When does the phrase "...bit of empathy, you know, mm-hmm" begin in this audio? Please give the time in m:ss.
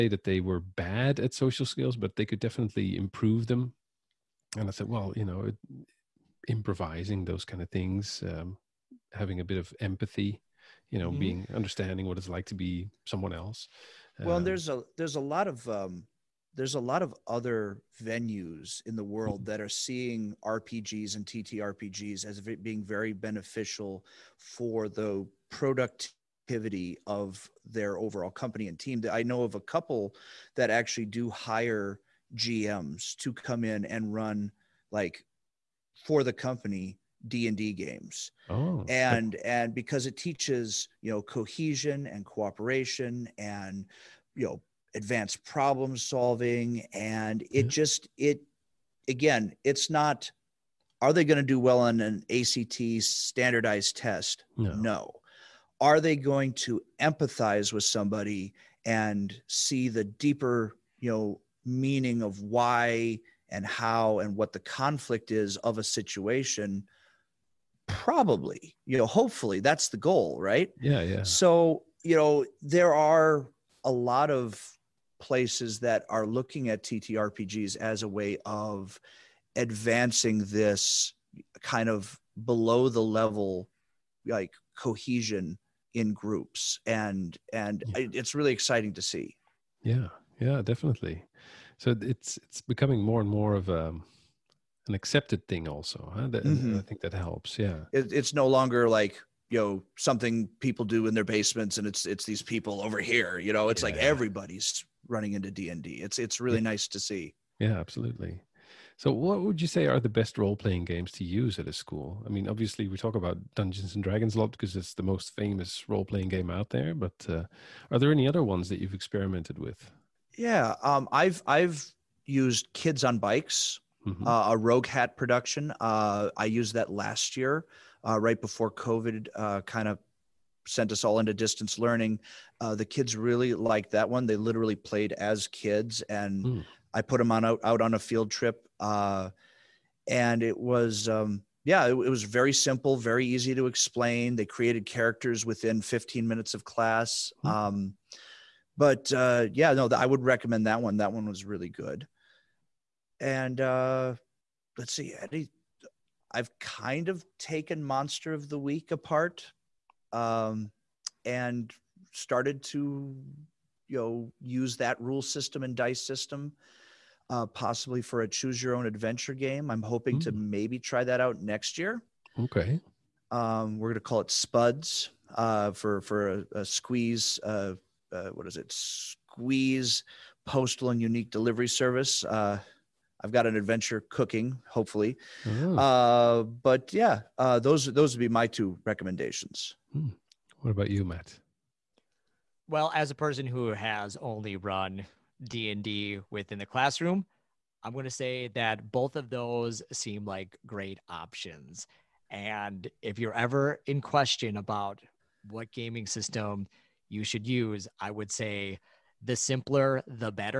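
0:09.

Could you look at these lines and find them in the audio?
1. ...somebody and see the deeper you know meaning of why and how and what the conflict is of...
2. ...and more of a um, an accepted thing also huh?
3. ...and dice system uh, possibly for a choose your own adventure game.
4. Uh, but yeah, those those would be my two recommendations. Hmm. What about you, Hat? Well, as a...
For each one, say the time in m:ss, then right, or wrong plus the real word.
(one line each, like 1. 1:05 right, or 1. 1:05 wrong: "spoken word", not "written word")
1. 0:57 right
2. 1:33 right
3. 2:45 right
4. 3:05 wrong: "Matt", not "Hat".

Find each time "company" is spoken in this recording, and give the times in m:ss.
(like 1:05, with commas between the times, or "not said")
0:28, 0:36.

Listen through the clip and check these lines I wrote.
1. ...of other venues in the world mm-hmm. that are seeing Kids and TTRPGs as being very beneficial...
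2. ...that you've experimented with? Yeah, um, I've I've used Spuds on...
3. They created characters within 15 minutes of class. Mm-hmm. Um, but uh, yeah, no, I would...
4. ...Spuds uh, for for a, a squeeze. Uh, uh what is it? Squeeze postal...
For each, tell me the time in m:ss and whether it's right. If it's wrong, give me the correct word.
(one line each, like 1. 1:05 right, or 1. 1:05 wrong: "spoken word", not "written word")
1. 0:17 wrong: "RPGs", not "Kids"
2. 1:58 wrong: "Kids", not "Spuds"
3. 2:24 right
4. 2:54 right.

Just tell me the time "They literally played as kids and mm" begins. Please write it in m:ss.
2:14.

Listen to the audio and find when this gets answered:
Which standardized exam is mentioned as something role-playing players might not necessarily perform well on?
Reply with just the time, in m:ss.
0:52.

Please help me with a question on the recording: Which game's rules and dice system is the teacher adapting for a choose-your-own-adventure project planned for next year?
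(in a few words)
Monster of the Week.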